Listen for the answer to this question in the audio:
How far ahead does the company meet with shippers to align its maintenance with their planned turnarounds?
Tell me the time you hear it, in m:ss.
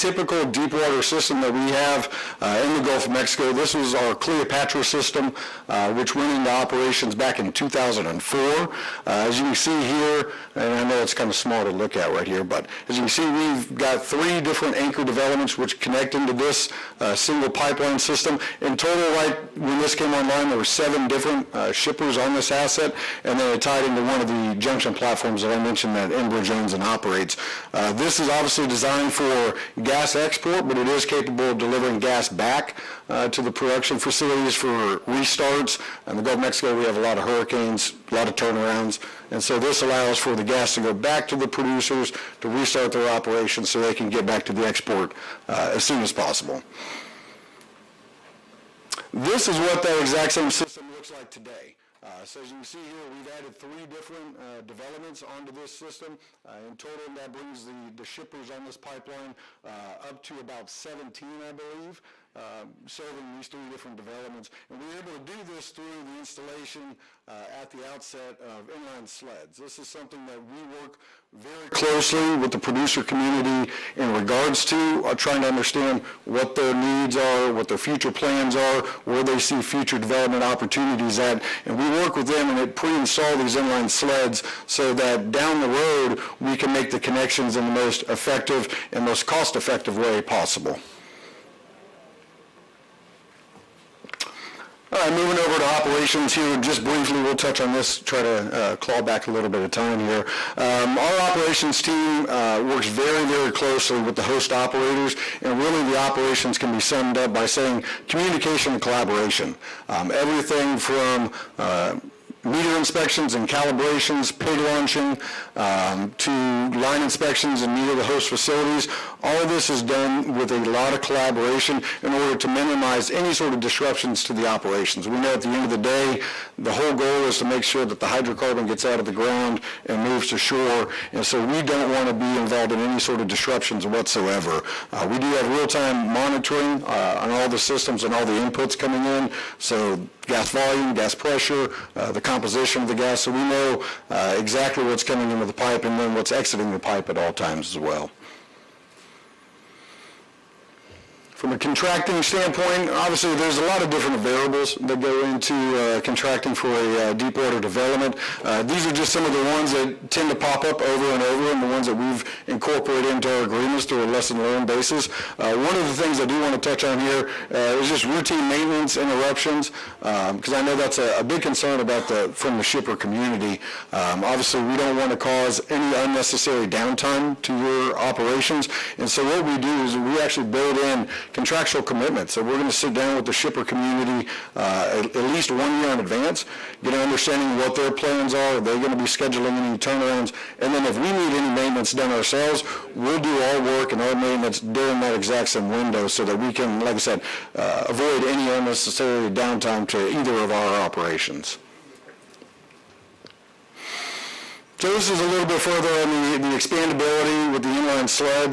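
3:05.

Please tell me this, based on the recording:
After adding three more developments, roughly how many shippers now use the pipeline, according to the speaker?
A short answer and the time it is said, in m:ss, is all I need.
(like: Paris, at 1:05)
17, at 1:00.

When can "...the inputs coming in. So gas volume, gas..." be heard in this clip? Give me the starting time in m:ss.
2:18.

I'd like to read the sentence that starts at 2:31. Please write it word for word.
From a contracting standpoint, obviously there's a lot of different variables that go into uh, contracting for a uh, deep water development.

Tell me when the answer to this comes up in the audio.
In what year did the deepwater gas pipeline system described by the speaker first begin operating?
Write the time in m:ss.
0:07.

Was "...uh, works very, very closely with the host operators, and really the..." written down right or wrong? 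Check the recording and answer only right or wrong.
right.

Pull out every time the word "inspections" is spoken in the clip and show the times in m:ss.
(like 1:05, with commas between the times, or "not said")
1:52, 1:57.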